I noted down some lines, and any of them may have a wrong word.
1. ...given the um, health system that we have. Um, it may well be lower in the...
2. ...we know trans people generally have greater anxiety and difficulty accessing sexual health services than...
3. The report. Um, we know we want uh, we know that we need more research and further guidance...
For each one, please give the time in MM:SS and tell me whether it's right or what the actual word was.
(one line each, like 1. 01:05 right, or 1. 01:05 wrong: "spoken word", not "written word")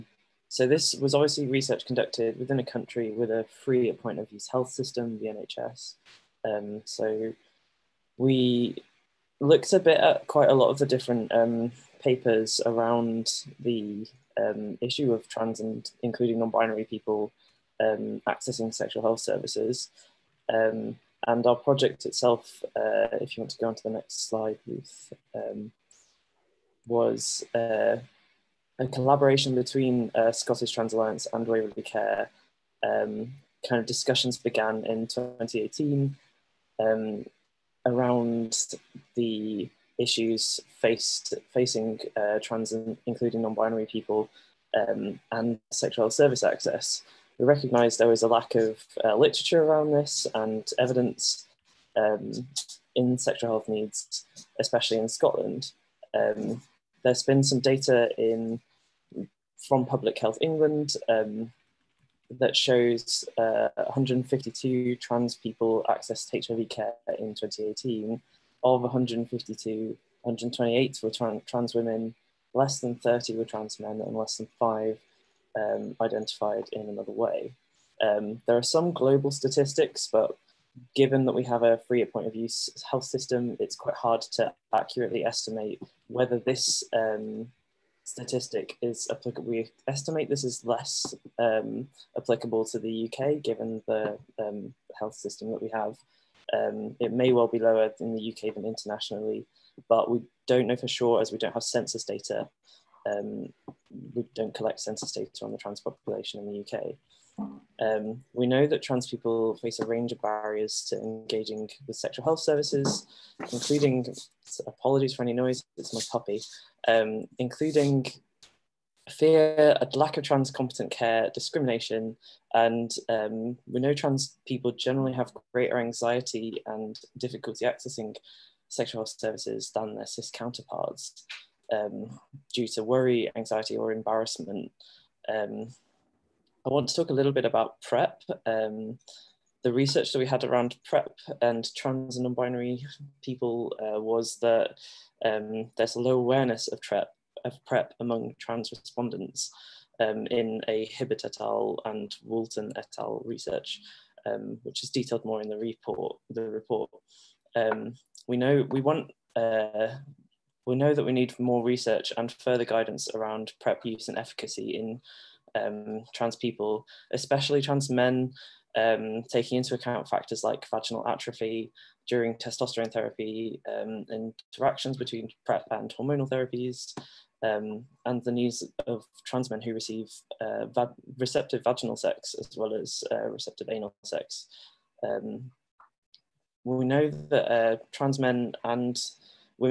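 1. 01:33 right
2. 02:03 right
3. 02:36 right.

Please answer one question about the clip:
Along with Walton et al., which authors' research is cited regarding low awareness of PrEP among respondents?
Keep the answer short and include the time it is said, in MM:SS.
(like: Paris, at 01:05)
Hibbert et al., at 02:30.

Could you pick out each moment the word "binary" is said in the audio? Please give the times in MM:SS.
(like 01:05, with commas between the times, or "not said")
00:16, 00:43, 02:22.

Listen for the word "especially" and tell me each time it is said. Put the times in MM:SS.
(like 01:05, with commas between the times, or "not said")
00:54, 02:47.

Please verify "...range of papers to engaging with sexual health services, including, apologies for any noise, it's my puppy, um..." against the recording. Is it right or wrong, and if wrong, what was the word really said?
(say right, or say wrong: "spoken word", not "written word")
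wrong: "barriers", not "papers".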